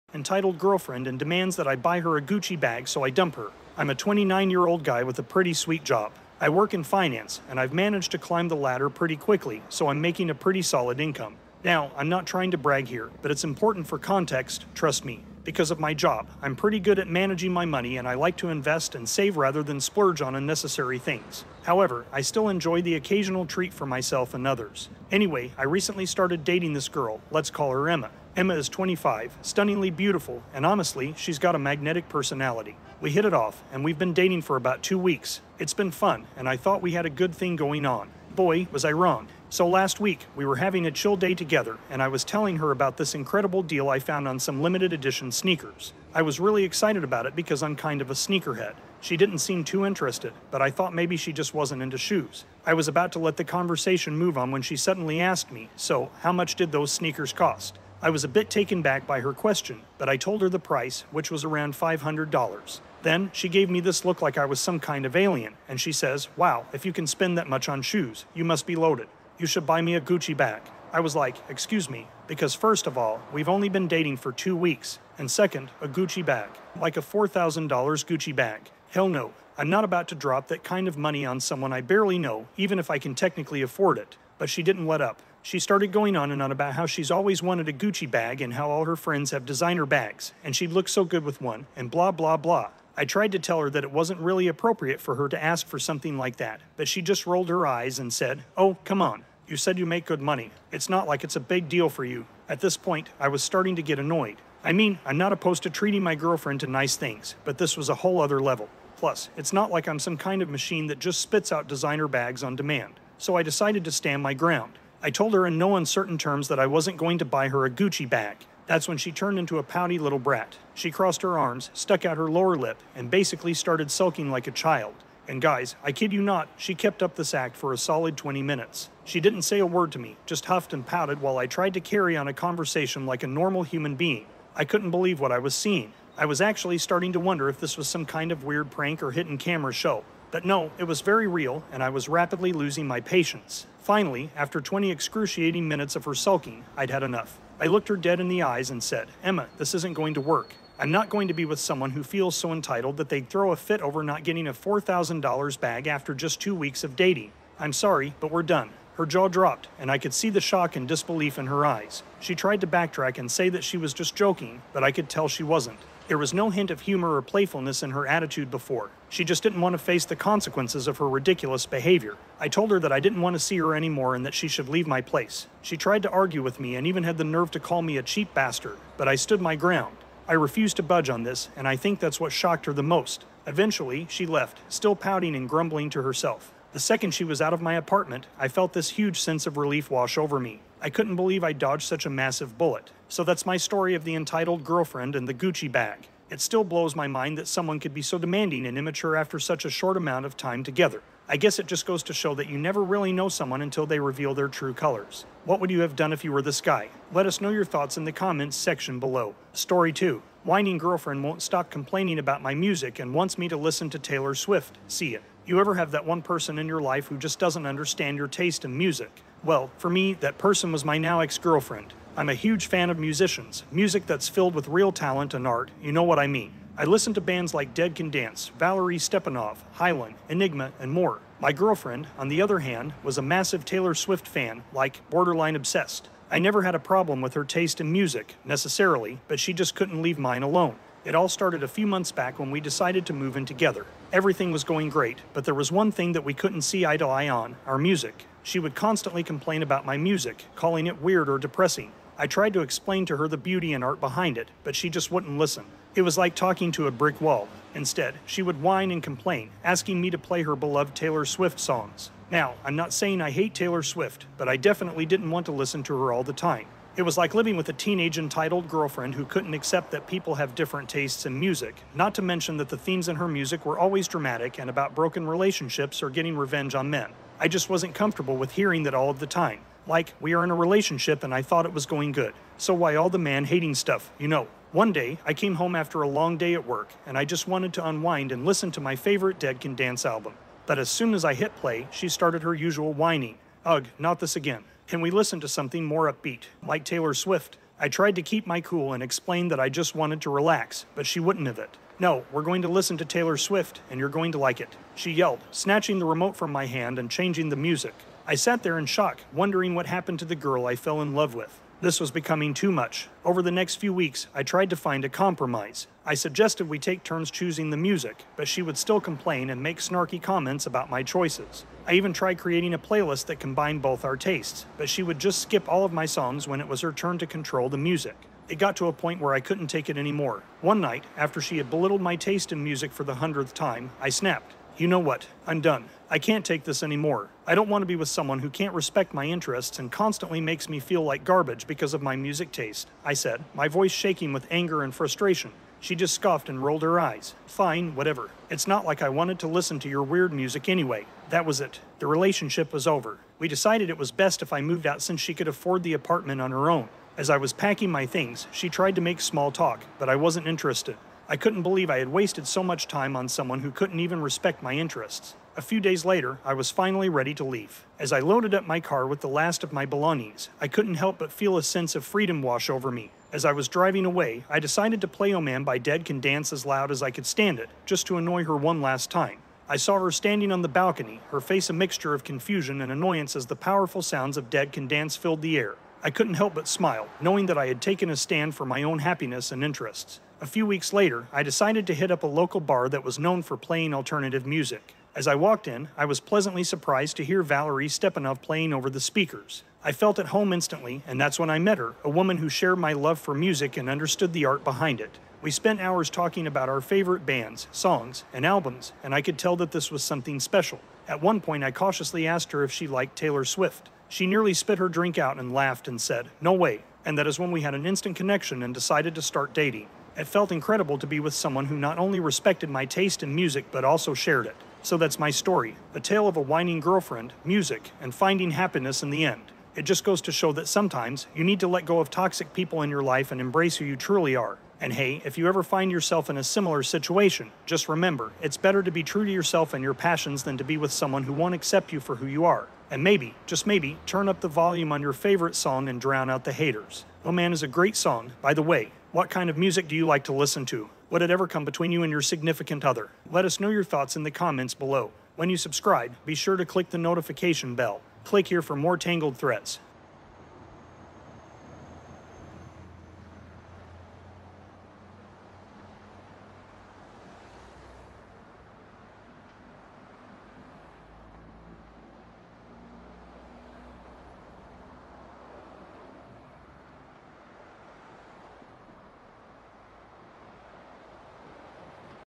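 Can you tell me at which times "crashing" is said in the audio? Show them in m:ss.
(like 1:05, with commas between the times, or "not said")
not said.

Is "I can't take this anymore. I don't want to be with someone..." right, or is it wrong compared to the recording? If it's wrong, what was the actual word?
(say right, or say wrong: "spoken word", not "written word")
right.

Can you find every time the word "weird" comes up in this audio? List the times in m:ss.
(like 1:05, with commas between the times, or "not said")
2:18, 4:11, 5:50.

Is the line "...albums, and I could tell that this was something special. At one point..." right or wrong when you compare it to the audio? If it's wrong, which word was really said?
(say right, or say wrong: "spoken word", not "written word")
right.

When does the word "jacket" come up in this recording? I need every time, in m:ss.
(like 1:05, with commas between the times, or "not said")
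not said.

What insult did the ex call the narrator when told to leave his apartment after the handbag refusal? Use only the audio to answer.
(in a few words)
cheap bastard.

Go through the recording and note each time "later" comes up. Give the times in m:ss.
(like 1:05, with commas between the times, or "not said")
6:06, 6:30.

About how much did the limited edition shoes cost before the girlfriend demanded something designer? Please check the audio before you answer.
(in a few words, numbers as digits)
$500.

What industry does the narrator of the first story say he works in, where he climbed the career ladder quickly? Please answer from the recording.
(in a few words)
finance.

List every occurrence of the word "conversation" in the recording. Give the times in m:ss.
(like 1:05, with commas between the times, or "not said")
0:53, 2:12.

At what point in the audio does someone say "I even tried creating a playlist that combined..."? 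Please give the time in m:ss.
5:21.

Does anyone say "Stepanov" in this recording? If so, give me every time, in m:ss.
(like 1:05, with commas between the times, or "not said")
3:48, 6:37.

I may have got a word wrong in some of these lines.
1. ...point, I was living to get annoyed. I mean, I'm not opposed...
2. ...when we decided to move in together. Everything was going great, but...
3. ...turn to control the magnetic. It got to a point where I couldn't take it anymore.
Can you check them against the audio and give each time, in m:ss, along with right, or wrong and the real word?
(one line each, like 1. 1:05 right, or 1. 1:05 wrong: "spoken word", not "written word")
1. 1:42 wrong: "starting", not "living"
2. 4:02 right
3. 5:26 wrong: "music", not "magnetic".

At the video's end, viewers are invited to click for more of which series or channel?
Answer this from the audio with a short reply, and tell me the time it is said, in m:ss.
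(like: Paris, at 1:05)
Tangled Threads, at 7:38.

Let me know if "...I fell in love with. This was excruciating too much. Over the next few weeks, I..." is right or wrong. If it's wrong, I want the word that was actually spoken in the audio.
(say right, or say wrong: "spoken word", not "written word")
wrong: "becoming", not "excruciating".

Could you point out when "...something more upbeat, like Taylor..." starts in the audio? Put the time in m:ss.
4:55.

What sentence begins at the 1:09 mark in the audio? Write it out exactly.
You should buy me a Gucci bag.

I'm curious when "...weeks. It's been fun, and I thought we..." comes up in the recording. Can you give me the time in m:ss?
0:34.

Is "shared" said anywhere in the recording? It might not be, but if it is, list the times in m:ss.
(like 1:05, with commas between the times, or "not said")
6:42, 7:04.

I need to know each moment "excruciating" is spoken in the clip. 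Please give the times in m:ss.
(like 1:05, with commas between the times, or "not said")
2:24.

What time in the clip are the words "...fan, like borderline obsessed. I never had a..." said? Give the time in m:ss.
3:54.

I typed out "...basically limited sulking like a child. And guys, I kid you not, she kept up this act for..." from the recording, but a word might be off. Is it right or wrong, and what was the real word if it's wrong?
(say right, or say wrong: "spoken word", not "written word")
wrong: "started", not "limited".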